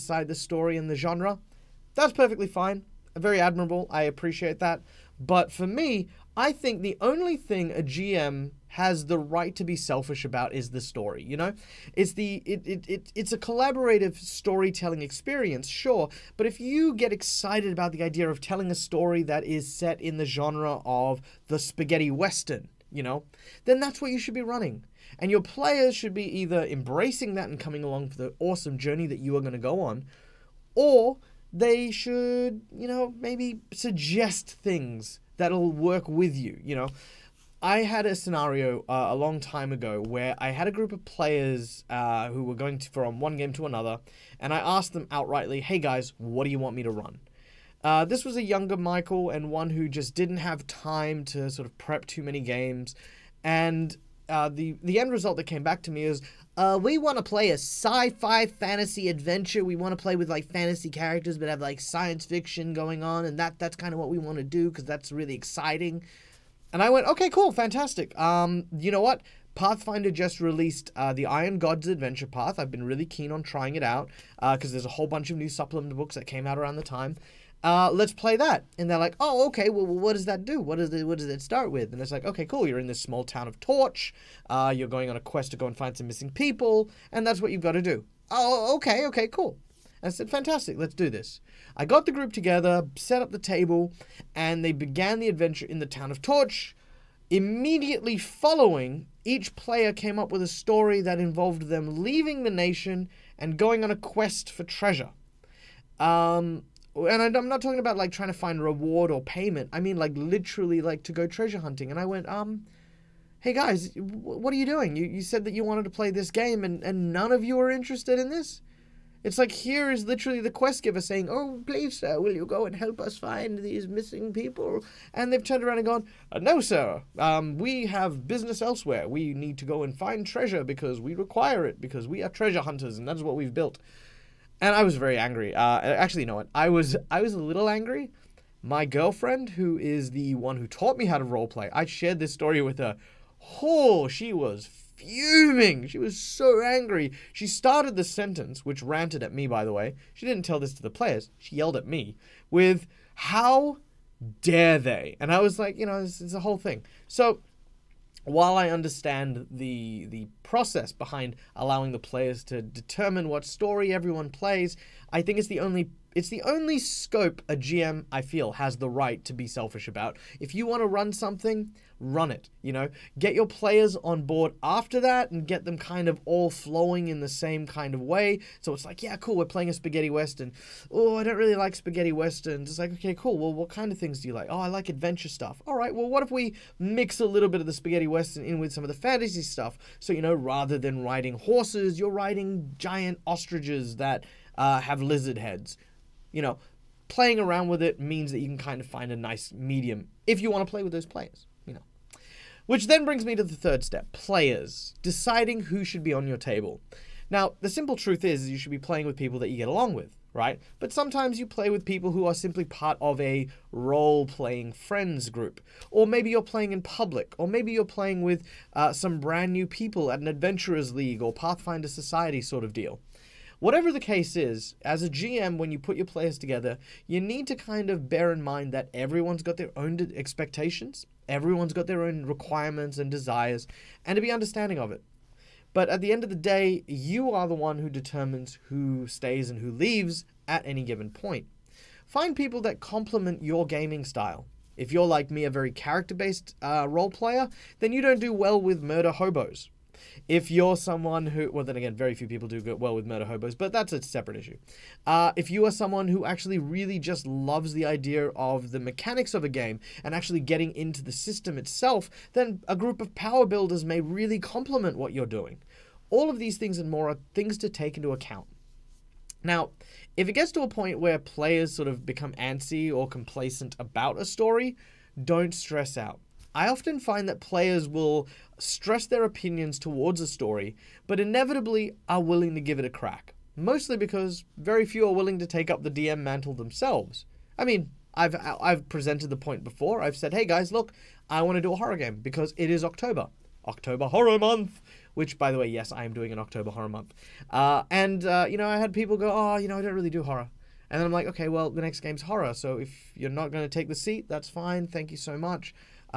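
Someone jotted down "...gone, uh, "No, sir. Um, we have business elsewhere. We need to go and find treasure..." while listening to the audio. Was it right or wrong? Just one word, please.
right.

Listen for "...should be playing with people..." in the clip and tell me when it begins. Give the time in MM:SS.
03:28.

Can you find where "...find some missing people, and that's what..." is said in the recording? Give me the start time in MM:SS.
01:25.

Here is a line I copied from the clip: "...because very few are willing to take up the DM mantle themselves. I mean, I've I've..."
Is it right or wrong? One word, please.
right.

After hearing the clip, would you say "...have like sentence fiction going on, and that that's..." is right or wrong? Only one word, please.
wrong.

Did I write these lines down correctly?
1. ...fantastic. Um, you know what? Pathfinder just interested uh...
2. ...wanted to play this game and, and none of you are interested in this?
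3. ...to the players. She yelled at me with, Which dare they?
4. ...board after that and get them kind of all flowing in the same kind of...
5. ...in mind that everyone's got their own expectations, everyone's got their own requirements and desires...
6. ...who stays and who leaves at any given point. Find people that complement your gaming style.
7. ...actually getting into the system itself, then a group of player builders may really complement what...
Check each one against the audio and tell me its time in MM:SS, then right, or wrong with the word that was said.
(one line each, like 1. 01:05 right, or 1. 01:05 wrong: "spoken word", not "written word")
1. 01:07 wrong: "released", not "interested"
2. 01:55 right
3. 02:30 wrong: "How", not "Which"
4. 02:54 right
5. 03:48 right
6. 03:58 right
7. 04:20 wrong: "power", not "player".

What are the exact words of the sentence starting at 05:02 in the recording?
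So if you're not going to take the seat, that's fine.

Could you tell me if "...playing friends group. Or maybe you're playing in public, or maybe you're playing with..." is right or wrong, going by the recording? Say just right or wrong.
right.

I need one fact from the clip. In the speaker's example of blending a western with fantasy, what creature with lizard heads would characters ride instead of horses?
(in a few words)
giant ostriches.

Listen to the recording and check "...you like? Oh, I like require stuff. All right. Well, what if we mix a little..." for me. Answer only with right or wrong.
wrong.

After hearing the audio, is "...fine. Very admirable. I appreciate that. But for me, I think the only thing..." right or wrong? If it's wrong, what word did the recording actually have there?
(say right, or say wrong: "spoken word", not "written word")
right.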